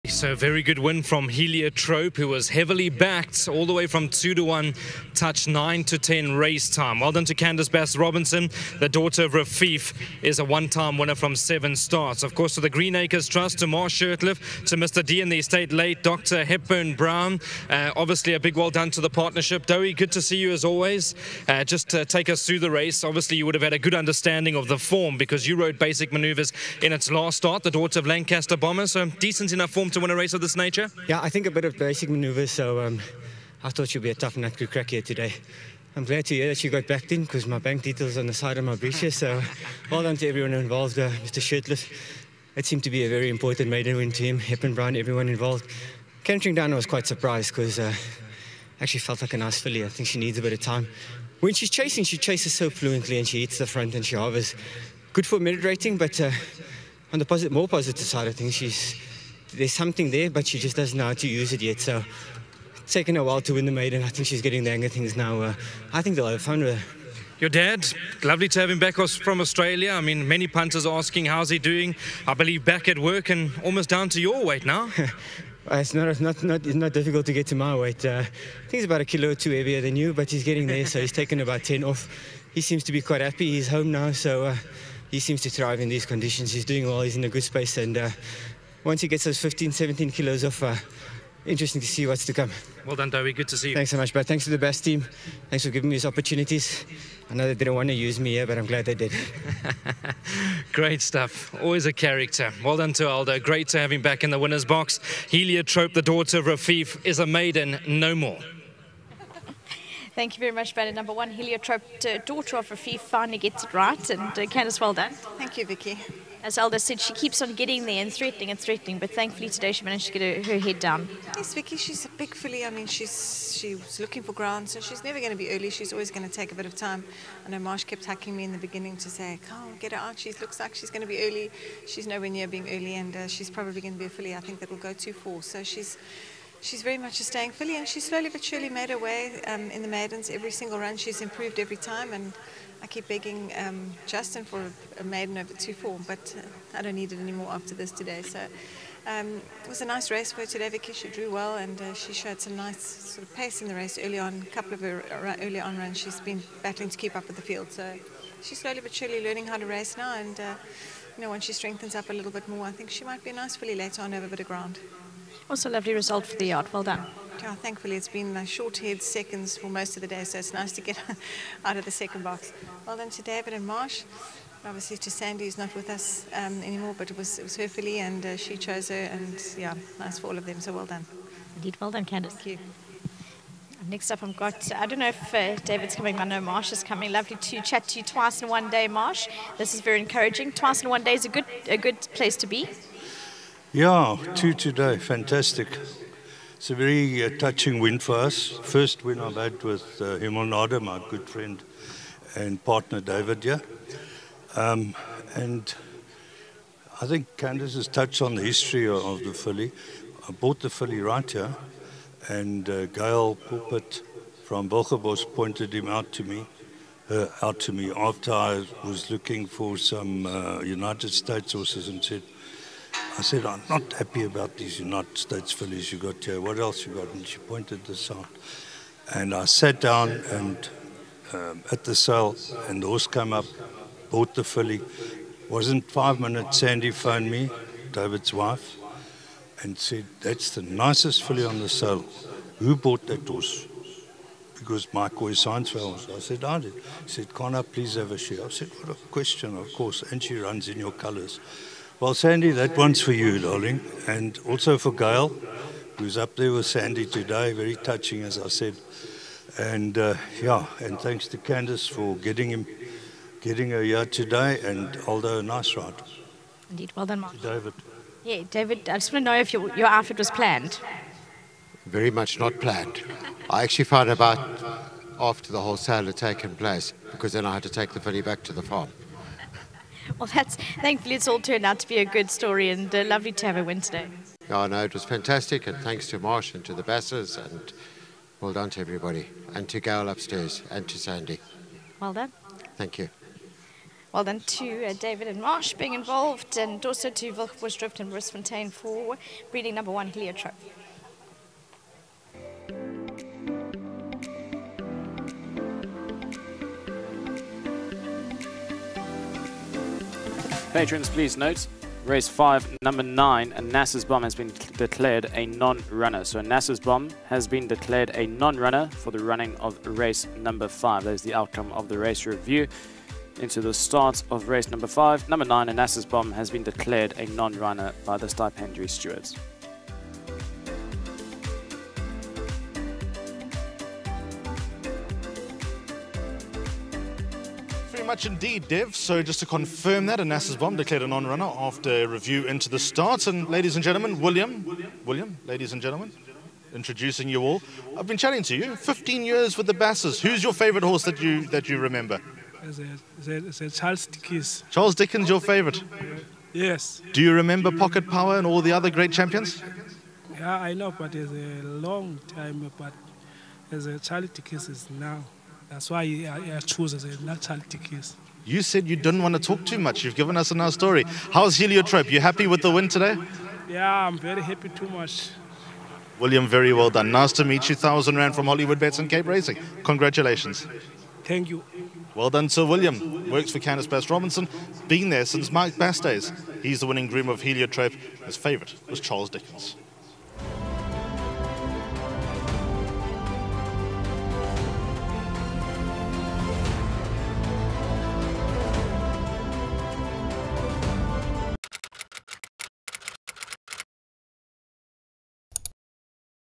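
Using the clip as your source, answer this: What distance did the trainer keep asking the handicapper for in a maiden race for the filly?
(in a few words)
2 form.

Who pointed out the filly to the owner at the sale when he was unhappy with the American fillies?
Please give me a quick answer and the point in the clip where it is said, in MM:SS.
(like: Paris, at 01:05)
Gail Pulpit, at 03:32.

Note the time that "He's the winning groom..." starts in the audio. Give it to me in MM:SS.
06:26.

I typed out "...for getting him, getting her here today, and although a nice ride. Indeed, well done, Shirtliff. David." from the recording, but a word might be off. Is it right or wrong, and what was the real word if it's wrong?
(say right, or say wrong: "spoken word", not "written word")
wrong: "Mark", not "Shirtliff".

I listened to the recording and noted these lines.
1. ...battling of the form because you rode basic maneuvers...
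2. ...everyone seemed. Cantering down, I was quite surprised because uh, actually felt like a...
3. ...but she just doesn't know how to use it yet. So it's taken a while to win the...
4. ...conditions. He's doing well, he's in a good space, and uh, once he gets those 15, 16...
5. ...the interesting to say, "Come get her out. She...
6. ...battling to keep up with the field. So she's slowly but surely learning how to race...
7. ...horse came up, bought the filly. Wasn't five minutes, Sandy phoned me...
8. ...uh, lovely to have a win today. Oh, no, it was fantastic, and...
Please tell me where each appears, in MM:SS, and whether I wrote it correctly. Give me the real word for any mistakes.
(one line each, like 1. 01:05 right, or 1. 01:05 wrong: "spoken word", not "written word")
1. 00:23 wrong: "understanding", not "battling"
2. 00:44 wrong: "involved", not "seemed"
3. 01:00 right
4. 01:26 wrong: "17", not "16"
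5. 02:08 wrong: "beginning", not "interesting"
6. 02:36 right
7. 03:52 right
8. 04:42 right.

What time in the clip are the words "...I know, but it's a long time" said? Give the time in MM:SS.
06:00.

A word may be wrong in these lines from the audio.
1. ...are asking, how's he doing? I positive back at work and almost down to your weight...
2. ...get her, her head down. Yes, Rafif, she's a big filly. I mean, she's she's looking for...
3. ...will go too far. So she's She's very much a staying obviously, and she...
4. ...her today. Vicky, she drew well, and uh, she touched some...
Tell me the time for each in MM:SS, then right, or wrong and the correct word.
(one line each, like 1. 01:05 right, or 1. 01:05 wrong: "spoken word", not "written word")
1. 01:10 wrong: "believe", not "positive"
2. 02:00 wrong: "Vicky", not "Rafif"
3. 02:14 wrong: "filly", not "obviously"
4. 02:30 wrong: "showed", not "touched".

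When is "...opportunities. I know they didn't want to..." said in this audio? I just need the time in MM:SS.
01:36.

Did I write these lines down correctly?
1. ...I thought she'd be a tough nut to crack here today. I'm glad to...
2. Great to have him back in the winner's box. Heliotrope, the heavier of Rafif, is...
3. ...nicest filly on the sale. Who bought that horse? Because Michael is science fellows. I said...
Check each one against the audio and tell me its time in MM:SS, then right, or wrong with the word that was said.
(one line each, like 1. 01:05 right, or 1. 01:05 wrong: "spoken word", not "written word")
1. 00:33 right
2. 01:43 wrong: "daughter", not "heavier"
3. 04:00 right.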